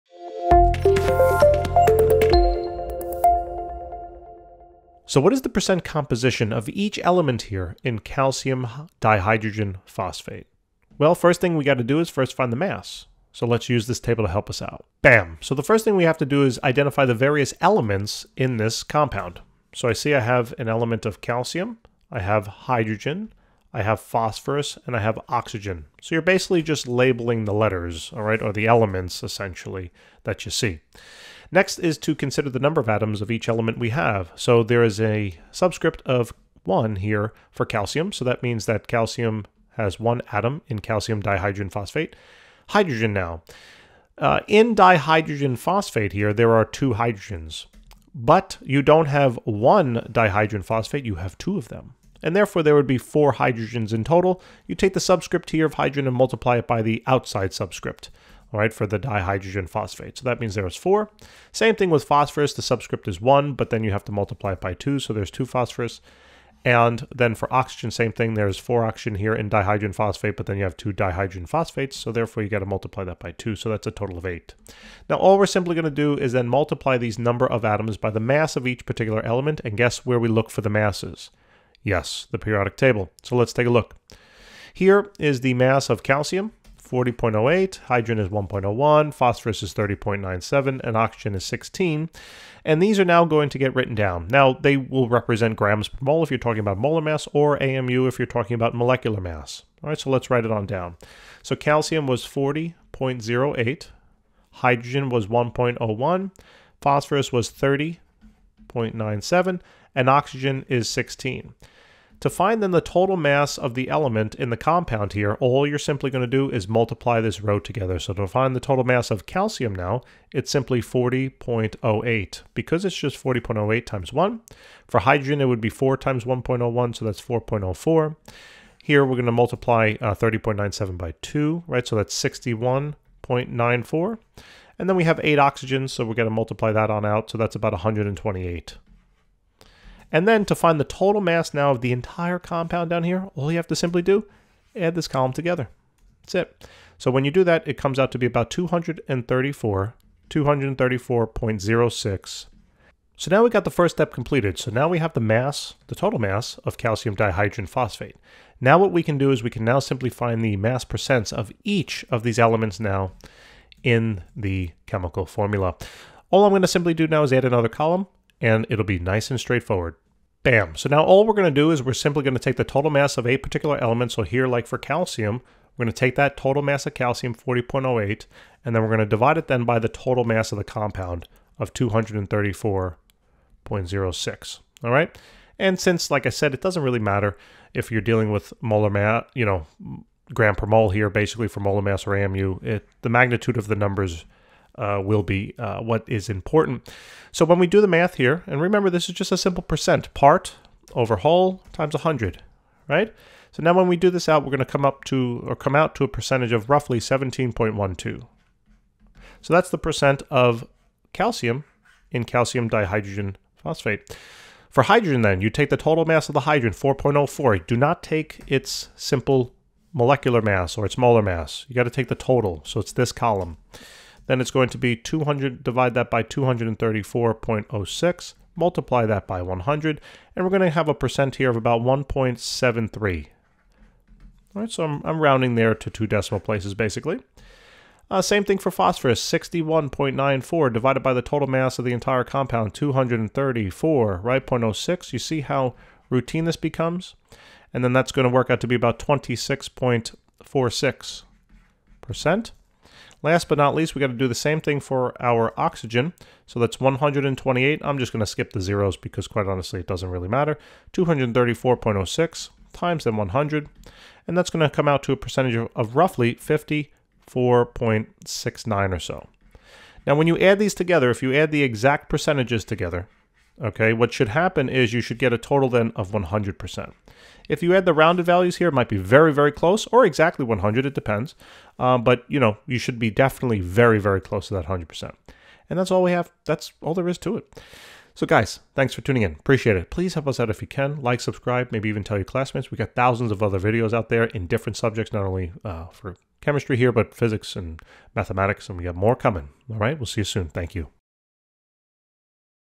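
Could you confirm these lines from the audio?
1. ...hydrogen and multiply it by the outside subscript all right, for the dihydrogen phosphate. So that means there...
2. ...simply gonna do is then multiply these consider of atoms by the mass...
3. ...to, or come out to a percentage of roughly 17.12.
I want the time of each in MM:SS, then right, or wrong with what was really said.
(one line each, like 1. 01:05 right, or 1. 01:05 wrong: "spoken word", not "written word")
1. 00:55 right
2. 01:15 wrong: "number", not "consider"
3. 03:25 right.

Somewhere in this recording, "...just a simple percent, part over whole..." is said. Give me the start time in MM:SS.
03:19.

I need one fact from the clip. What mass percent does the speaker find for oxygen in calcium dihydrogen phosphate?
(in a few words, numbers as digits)
54.69%.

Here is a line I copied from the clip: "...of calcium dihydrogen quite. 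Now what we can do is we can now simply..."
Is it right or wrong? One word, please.
wrong.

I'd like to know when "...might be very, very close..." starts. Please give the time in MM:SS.
04:38.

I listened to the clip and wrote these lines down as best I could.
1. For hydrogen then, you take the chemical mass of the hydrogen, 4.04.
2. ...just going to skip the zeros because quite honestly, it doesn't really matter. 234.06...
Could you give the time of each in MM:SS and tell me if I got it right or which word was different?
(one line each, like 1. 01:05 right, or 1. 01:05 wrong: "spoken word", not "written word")
1. 03:34 wrong: "total", not "chemical"
2. 04:17 right.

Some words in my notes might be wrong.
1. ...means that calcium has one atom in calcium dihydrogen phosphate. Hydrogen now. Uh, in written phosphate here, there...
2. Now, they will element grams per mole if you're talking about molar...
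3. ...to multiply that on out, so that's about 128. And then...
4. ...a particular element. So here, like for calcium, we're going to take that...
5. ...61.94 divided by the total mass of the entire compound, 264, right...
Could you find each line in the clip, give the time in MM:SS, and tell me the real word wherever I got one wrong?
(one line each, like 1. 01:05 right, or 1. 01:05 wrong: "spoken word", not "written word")
1. 00:38 wrong: "dihydrogen", not "written"
2. 01:34 wrong: "represent", not "element"
3. 02:16 right
4. 02:53 right
5. 03:59 wrong: "234", not "264".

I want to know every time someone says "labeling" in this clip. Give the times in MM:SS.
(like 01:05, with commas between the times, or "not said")
00:26.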